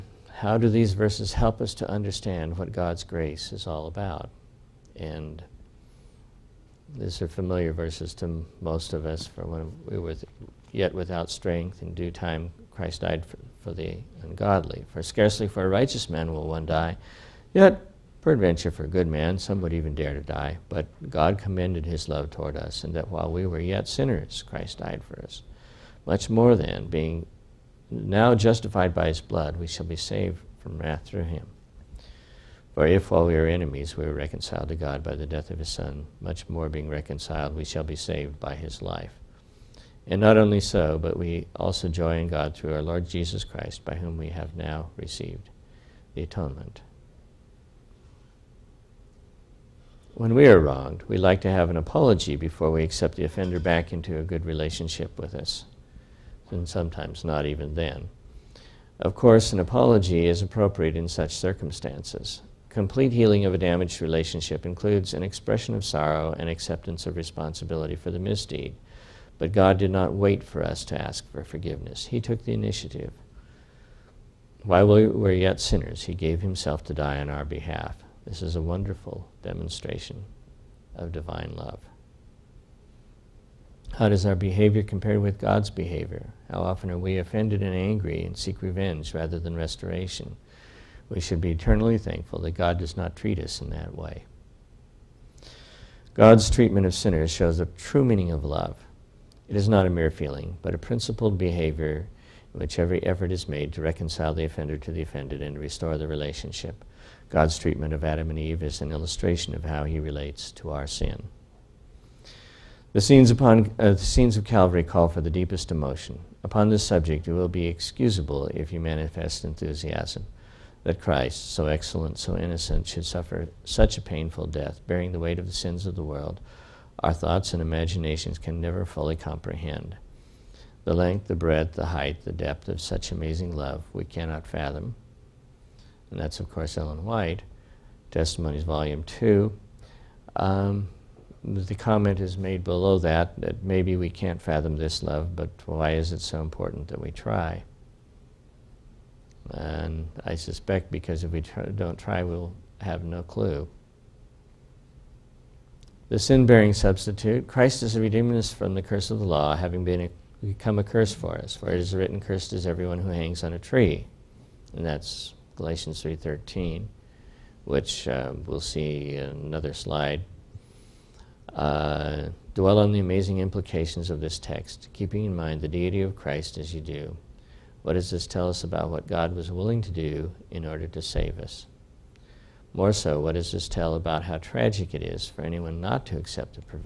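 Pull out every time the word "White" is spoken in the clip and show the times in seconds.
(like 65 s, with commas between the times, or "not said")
137 s.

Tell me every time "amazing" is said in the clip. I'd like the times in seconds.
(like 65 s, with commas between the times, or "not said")
133 s, 172 s.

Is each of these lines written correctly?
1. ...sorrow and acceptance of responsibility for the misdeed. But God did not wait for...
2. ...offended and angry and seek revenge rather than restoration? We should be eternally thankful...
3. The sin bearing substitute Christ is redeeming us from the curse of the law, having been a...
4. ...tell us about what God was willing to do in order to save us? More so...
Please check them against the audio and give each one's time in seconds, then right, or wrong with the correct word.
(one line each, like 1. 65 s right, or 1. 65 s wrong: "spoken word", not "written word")
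1. 65 s right
2. 87 s right
3. 156 s right
4. 178 s right.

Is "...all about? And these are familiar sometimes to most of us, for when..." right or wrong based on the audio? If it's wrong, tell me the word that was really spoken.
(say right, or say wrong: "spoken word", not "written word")
wrong: "verses", not "sometimes".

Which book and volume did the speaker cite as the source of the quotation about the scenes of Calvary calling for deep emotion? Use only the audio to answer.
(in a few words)
Testimonies, Volume 2.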